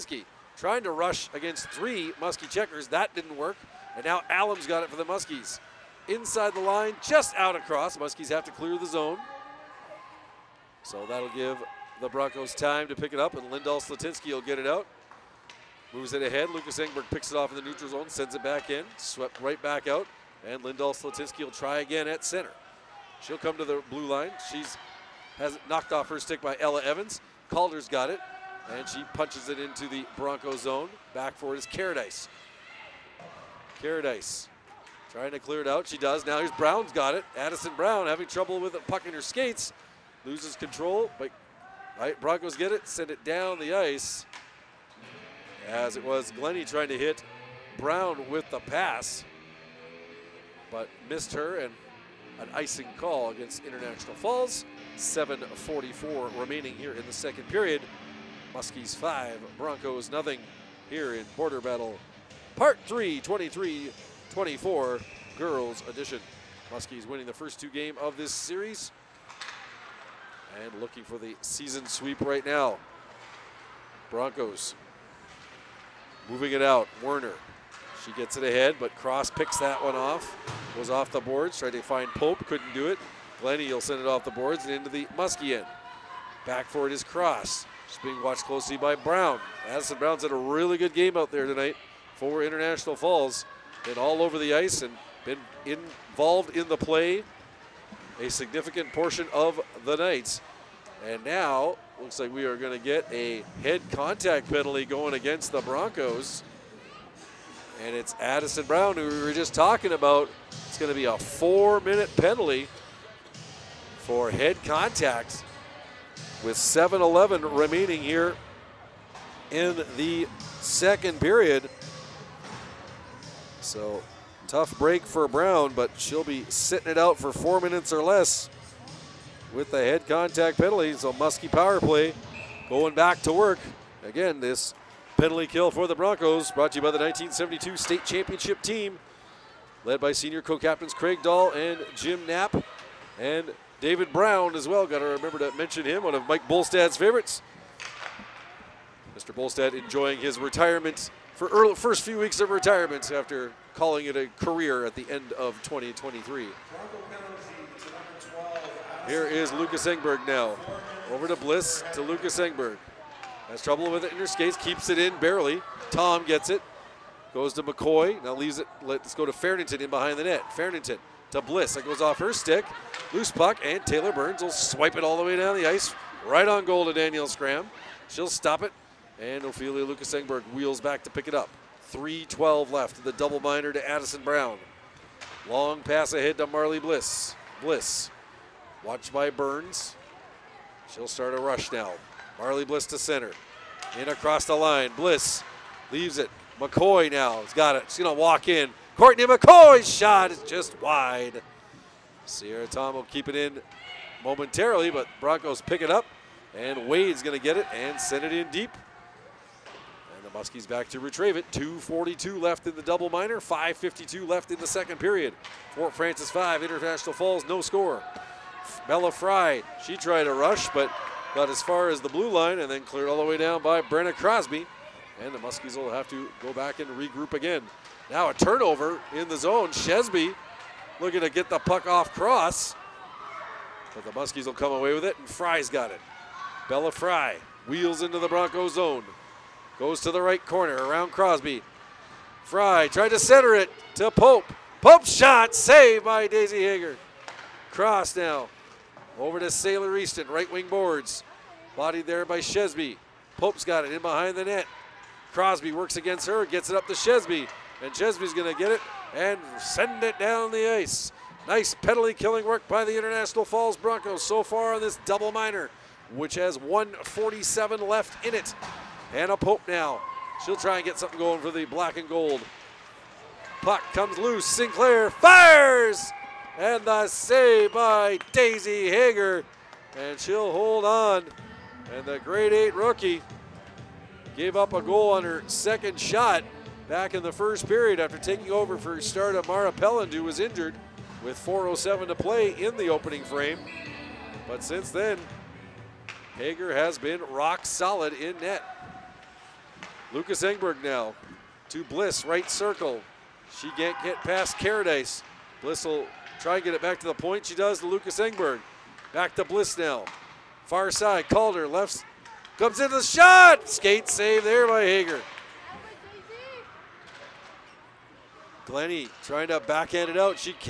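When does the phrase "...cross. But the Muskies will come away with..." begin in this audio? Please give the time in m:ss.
3:52.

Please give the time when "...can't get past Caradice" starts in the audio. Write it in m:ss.
5:03.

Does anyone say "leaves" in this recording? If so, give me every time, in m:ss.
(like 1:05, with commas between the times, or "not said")
2:48, 3:15.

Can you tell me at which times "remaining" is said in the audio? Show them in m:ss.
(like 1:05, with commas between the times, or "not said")
0:56, 1:57.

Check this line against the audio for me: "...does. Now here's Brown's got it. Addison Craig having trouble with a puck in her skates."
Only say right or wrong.
wrong.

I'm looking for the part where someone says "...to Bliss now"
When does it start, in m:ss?
5:09.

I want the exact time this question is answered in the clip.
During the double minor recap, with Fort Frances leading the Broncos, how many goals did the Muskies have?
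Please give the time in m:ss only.
3:35.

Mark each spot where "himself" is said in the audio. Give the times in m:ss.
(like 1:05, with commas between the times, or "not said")
not said.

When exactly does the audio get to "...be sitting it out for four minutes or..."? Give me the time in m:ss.
2:06.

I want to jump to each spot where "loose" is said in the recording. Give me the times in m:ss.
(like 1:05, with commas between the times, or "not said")
2:53, 4:34.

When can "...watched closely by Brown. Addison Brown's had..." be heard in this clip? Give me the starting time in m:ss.
1:28.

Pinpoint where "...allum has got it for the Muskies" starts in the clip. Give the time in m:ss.
0:04.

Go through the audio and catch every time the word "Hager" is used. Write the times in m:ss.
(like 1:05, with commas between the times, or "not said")
4:06, 4:38, 4:56, 5:14.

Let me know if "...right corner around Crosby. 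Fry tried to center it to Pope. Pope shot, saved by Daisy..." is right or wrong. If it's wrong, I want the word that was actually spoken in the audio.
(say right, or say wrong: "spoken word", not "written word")
right.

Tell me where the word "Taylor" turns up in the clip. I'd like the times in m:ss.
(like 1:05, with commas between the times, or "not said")
2:53.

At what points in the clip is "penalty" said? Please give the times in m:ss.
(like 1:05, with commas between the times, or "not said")
1:44, 1:52, 2:10, 2:15, 4:21.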